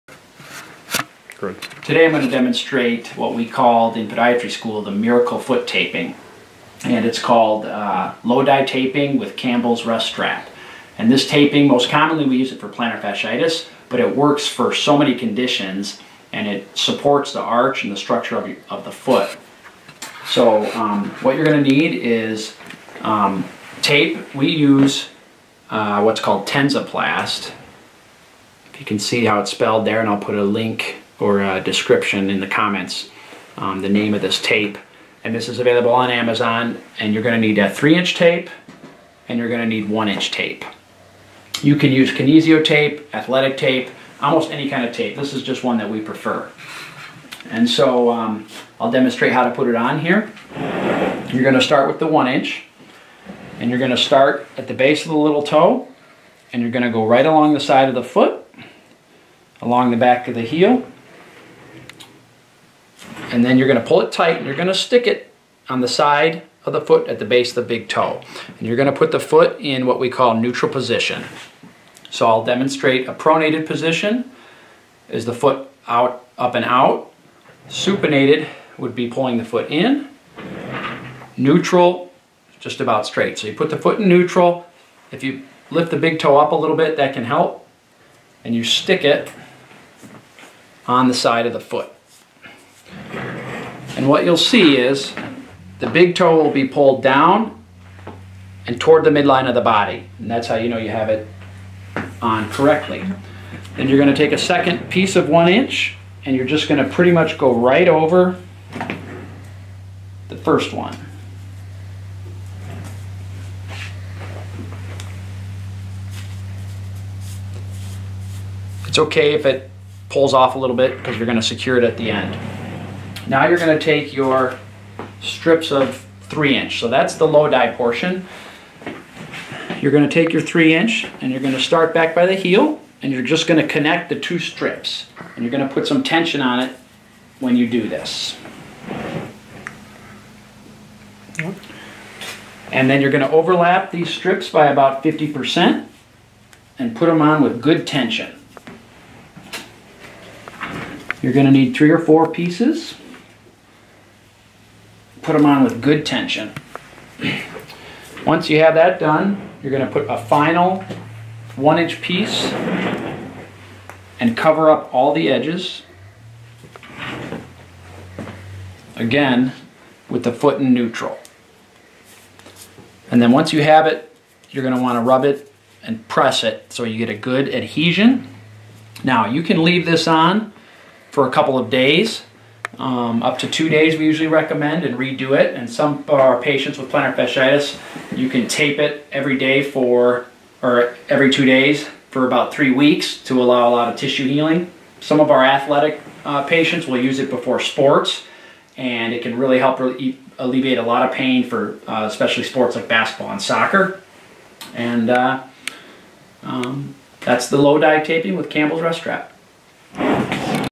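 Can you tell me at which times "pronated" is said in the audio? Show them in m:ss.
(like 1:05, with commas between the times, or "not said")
1:13.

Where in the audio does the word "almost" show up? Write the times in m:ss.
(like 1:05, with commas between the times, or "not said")
0:44.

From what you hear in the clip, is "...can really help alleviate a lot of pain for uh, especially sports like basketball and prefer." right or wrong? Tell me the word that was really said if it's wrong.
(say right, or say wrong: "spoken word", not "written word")
wrong: "soccer", not "prefer".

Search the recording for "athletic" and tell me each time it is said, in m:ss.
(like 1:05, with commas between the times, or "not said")
0:43, 3:15.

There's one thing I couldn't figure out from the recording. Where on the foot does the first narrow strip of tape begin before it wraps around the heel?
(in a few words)
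base of the little toe.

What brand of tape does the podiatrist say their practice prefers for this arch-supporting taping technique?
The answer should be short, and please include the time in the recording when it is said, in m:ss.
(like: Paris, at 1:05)
Tensoplast, at 0:26.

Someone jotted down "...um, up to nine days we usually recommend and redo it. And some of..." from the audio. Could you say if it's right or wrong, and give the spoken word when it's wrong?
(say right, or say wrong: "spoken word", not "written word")
wrong: "two", not "nine".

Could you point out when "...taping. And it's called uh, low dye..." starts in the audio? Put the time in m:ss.
0:05.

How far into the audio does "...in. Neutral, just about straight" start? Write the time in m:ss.
1:19.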